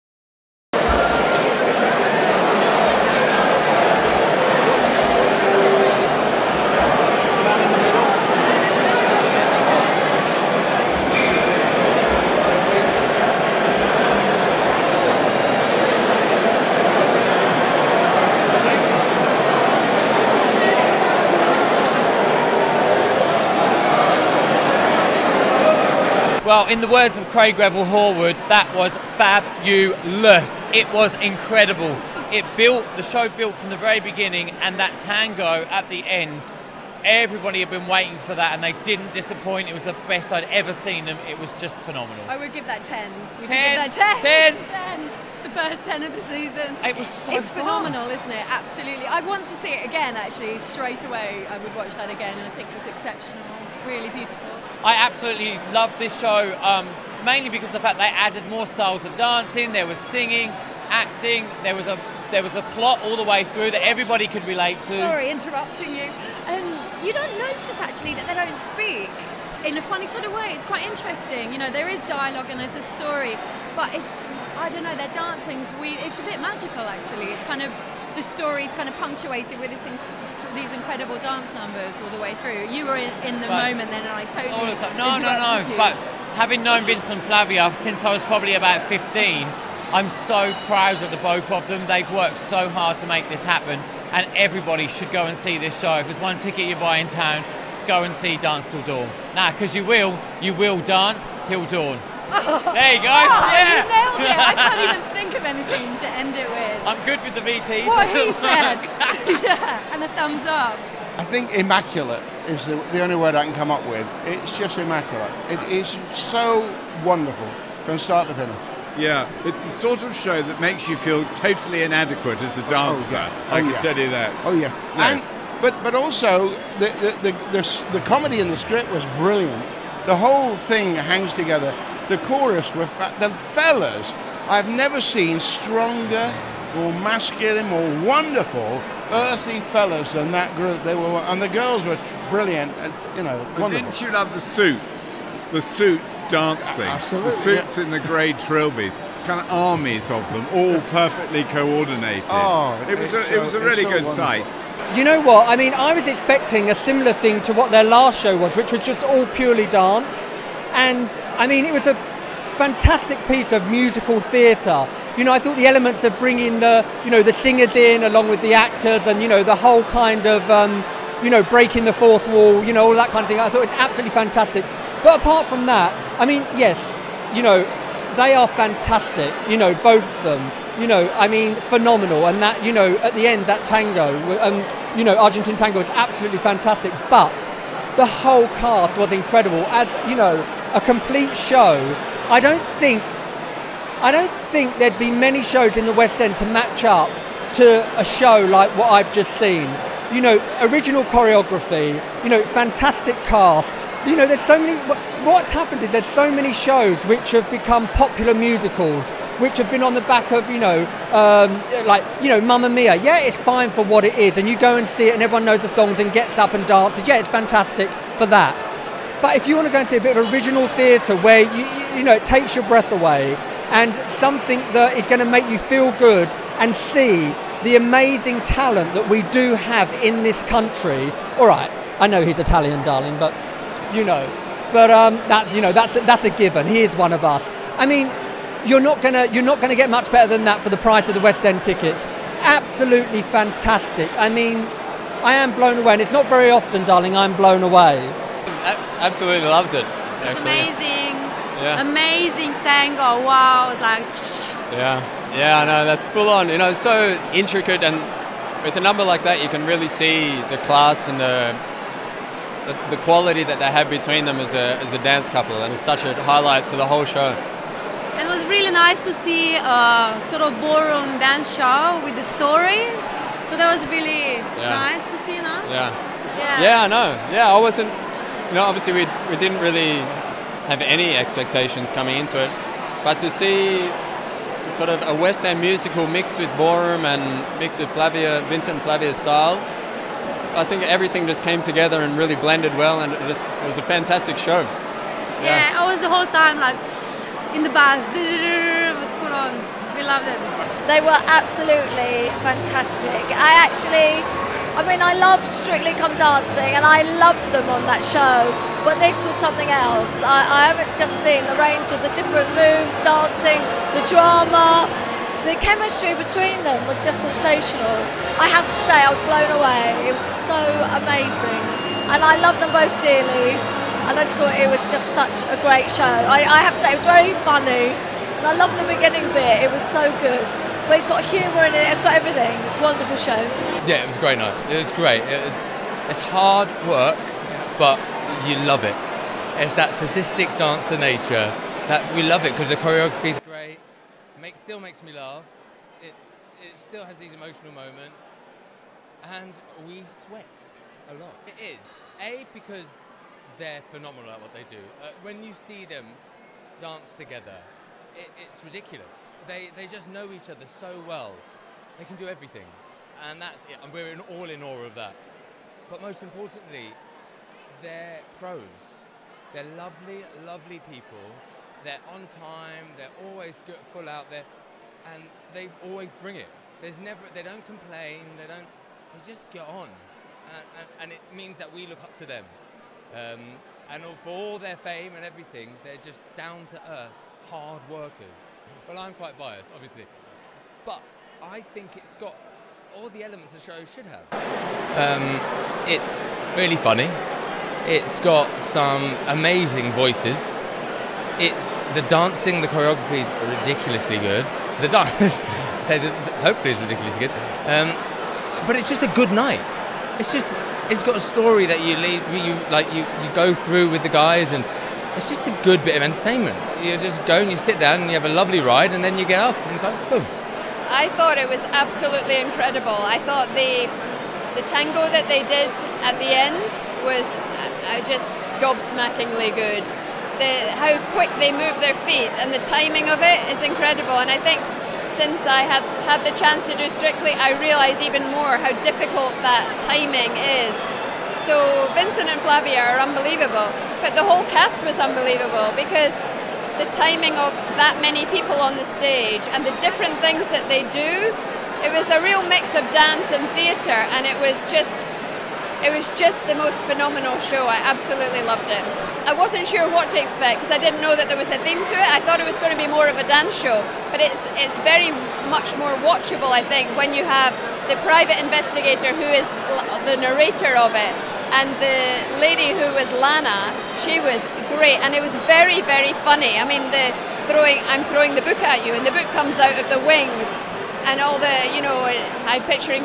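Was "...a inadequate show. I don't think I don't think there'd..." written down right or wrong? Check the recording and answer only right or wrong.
wrong.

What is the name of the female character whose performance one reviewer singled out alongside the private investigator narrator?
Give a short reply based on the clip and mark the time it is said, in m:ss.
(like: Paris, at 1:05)
Lana, at 7:53.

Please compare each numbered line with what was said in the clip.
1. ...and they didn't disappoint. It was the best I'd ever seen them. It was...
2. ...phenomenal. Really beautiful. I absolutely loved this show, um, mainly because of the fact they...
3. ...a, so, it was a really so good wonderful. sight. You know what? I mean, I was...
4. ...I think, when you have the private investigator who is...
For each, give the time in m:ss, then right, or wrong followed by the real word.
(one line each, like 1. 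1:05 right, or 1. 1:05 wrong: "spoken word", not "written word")
1. 0:38 right
2. 0:52 wrong: "exceptional", not "phenomenal"
3. 2:33 right
4. 7:46 right.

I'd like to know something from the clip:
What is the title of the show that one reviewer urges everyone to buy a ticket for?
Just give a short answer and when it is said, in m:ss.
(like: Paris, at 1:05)
Dance Til Dawn, at 1:38.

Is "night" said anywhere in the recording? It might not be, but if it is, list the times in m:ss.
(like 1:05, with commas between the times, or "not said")
5:34, 6:49.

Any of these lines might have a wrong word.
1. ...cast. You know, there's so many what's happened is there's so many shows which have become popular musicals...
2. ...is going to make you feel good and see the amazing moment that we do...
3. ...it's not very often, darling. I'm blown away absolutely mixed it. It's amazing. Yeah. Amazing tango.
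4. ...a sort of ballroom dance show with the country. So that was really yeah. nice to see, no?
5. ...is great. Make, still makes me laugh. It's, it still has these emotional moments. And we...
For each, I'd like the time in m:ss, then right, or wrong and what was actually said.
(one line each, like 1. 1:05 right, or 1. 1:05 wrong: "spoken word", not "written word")
1. 3:23 right
2. 3:44 wrong: "talent", not "moment"
3. 4:06 wrong: "loved", not "mixed"
4. 4:29 wrong: "story", not "country"
5. 5:43 right.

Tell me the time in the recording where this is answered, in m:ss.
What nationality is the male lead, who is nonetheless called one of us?
3:52.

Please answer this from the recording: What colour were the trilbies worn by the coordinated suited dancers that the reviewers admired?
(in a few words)
Grey.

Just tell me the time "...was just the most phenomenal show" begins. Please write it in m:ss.
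7:35.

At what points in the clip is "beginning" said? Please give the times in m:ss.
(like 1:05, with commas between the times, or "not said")
0:34, 5:28.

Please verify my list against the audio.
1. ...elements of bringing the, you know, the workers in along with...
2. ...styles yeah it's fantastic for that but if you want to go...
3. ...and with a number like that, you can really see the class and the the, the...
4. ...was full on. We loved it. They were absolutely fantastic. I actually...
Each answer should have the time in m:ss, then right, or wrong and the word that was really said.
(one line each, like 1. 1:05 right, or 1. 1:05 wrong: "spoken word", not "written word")
1. 2:45 wrong: "singers", not "workers"
2. 3:36 wrong: "dances", not "styles"
3. 4:17 right
4. 4:58 right.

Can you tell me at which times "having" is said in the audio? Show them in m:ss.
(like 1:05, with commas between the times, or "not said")
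1:26.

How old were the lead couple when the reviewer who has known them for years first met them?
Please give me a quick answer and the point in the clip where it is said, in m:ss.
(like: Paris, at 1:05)
15, at 1:28.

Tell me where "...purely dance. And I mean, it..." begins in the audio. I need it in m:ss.
2:39.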